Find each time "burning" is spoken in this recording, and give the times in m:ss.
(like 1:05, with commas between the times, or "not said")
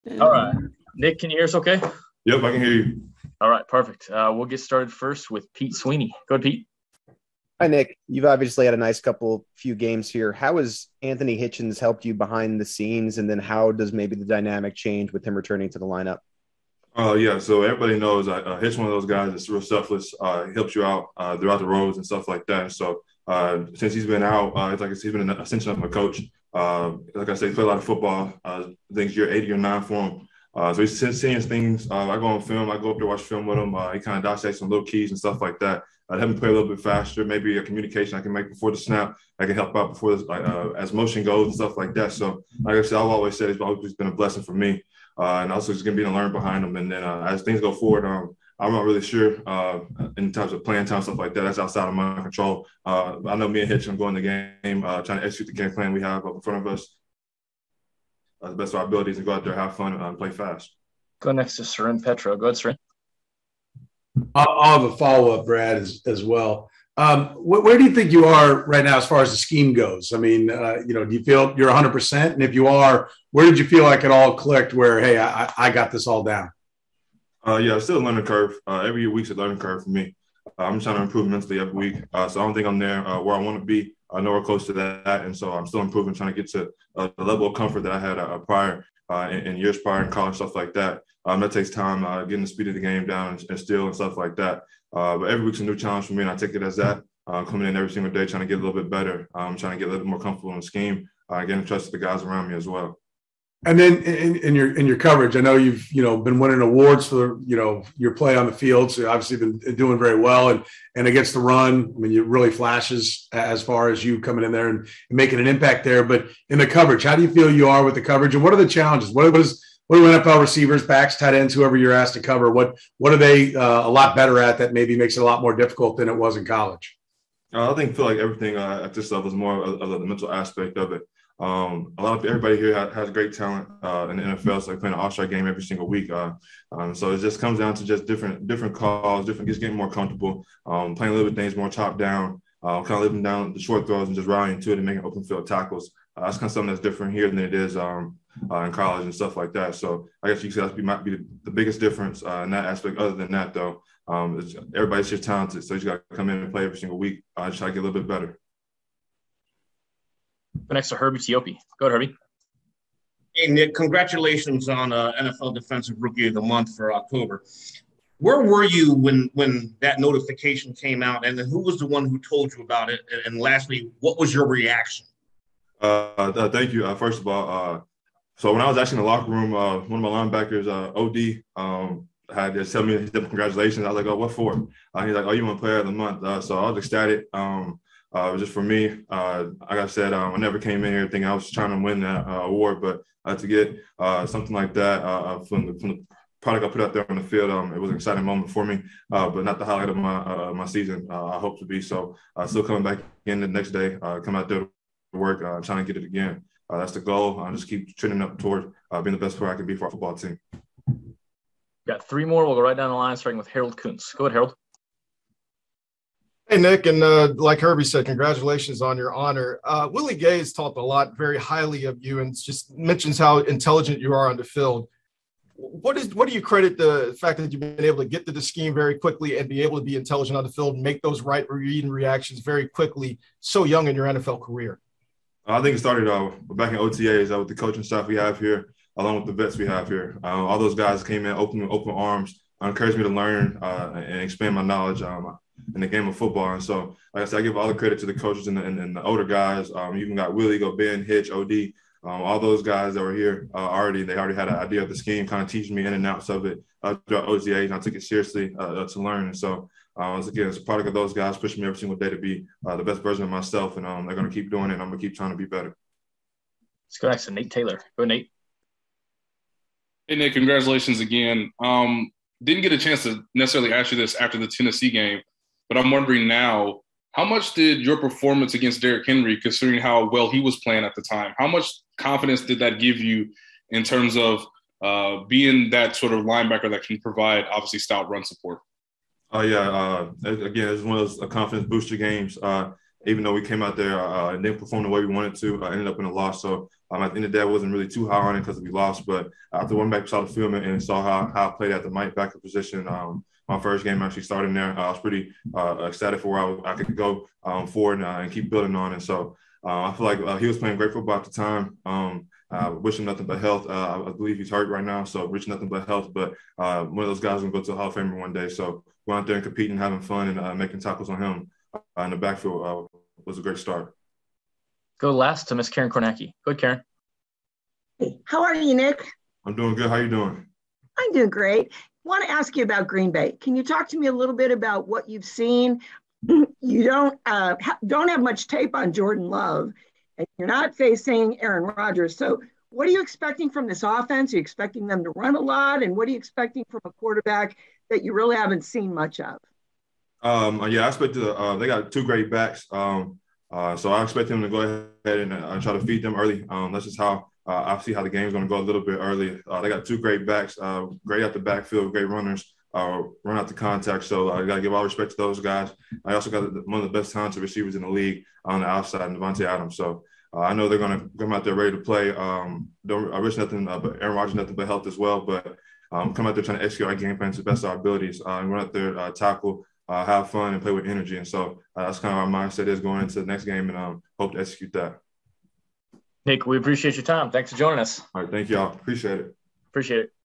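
not said.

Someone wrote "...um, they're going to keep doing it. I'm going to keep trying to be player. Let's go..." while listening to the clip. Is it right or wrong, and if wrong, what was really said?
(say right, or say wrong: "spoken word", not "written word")
wrong: "better", not "player".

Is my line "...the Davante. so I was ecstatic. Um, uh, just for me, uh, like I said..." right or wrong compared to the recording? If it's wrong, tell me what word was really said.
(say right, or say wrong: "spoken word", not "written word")
wrong: "Month", not "Davante".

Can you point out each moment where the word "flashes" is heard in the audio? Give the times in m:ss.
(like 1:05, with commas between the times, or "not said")
1:52.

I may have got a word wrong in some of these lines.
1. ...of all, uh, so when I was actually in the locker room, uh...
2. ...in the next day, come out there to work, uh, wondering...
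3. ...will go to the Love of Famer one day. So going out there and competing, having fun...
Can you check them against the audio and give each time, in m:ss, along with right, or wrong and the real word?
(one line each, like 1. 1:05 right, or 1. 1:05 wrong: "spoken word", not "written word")
1. 2:57 right
2. 3:23 wrong: "trying", not "wondering"
3. 5:17 wrong: "Hall", not "Love".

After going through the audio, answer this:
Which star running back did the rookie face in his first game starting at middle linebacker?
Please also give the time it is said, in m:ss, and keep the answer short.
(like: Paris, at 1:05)
Derrick Henry, at 4:38.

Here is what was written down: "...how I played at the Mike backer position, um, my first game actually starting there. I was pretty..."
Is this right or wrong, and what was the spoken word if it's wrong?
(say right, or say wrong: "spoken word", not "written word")
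right.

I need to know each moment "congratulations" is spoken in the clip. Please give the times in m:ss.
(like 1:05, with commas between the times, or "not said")
2:43, 3:03, 3:38, 4:30.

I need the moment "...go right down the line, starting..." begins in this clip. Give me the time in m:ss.
3:32.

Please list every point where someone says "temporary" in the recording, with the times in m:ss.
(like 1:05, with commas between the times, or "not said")
not said.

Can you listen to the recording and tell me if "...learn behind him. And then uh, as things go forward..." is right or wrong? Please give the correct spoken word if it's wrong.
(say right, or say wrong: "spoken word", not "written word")
right.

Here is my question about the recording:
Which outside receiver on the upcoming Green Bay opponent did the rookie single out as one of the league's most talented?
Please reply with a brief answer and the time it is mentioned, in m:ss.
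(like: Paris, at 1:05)
Davante Adams, at 6:09.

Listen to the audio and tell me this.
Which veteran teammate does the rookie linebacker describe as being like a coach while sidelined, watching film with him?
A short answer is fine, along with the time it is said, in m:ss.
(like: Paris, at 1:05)
Anthony Hitchens, at 0:11.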